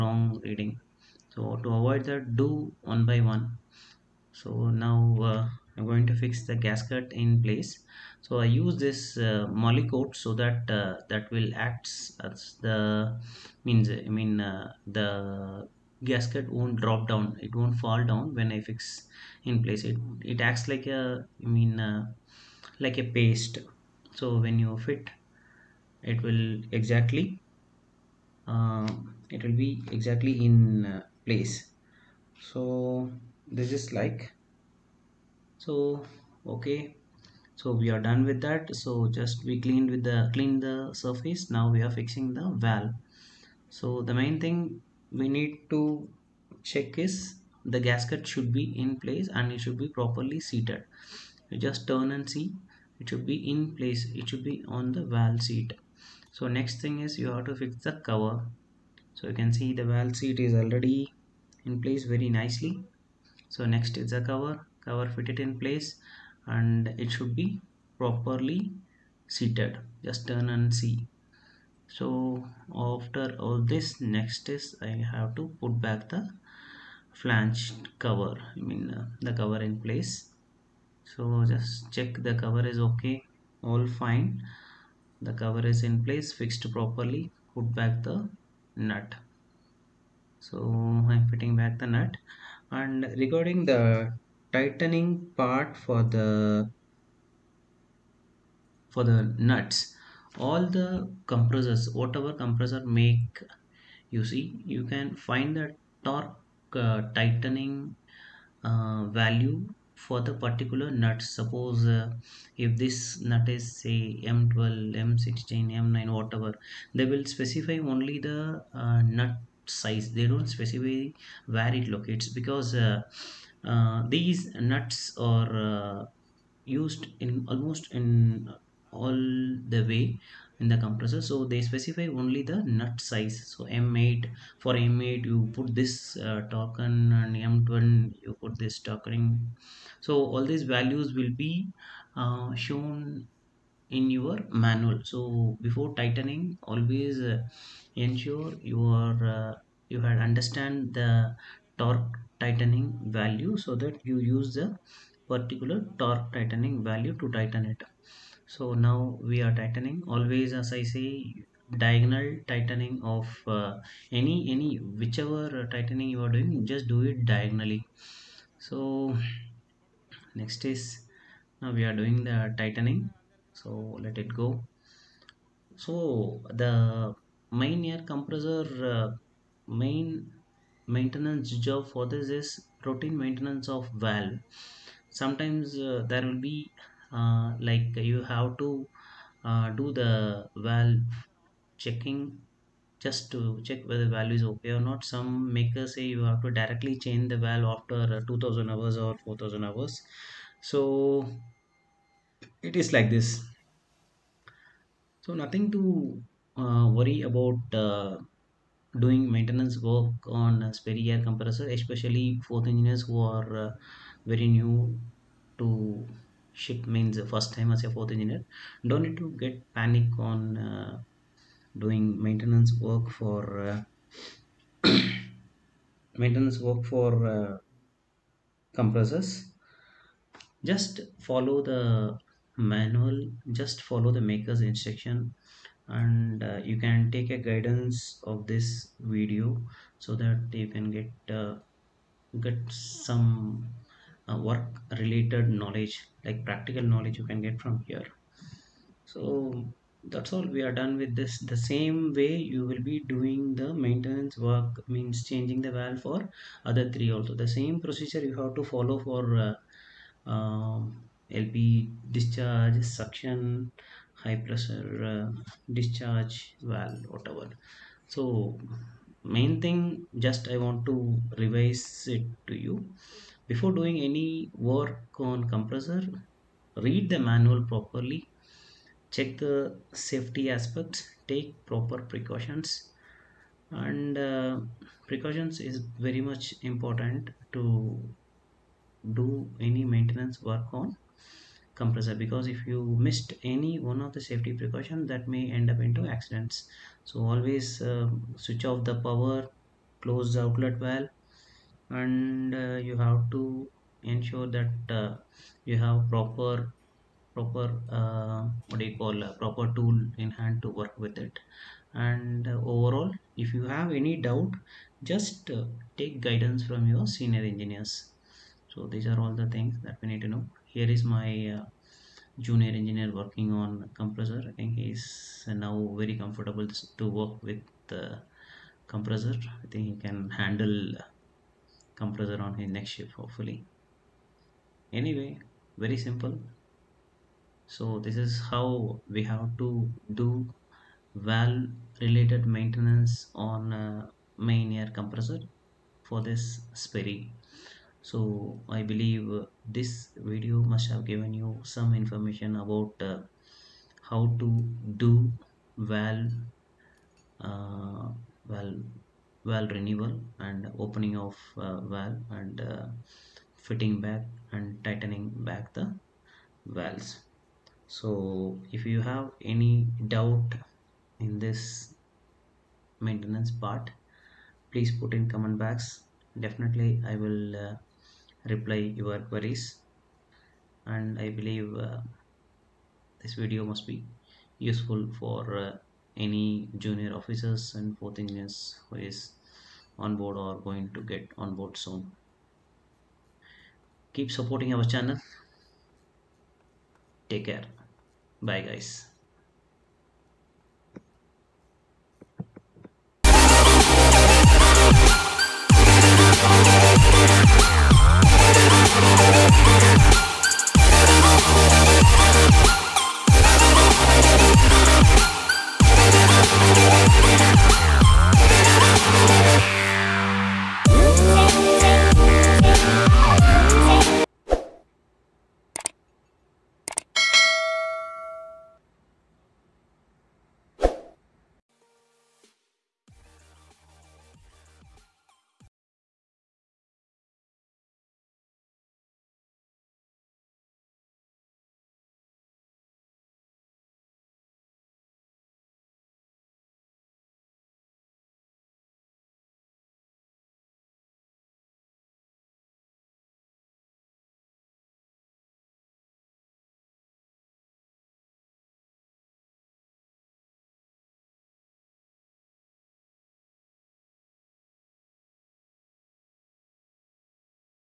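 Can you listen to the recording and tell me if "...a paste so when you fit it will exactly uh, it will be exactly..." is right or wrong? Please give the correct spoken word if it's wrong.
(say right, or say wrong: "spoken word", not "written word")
right.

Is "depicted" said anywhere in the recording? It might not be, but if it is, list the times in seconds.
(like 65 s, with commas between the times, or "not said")
not said.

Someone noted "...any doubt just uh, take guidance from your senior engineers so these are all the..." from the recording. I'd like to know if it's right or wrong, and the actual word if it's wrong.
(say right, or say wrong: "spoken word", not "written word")
right.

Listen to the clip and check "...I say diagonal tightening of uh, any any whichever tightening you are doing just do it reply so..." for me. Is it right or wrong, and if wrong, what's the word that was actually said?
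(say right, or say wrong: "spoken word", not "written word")
wrong: "diagonally", not "reply".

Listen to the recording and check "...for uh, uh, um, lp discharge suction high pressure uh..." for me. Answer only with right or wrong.
right.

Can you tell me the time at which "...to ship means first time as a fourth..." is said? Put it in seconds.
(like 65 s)
215 s.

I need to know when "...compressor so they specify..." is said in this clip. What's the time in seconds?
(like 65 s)
130 s.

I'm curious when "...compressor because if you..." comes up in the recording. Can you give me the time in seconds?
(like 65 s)
291 s.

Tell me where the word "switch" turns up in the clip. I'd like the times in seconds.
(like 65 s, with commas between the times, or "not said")
298 s.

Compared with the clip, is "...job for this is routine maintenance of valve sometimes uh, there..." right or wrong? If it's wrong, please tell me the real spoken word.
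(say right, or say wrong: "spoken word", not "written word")
right.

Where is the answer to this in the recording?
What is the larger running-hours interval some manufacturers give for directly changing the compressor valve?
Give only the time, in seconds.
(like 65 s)
199 s.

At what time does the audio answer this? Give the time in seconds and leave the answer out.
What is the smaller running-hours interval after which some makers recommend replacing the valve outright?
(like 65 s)
198 s.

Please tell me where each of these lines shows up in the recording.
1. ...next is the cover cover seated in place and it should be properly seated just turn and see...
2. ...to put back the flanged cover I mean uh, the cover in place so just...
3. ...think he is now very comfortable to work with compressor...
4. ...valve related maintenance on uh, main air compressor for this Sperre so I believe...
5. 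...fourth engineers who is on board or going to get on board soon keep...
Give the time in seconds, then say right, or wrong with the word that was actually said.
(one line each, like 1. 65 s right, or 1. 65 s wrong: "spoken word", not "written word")
1. 63 s wrong: "fitted", not "seated"
2. 75 s right
3. 324 s right
4. 341 s right
5. 387 s right.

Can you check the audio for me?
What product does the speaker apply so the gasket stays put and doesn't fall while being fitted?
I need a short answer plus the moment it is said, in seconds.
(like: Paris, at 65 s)
Molykote, at 9 s.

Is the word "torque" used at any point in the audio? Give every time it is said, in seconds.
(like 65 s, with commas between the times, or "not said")
106 s, 151 s, 155 s.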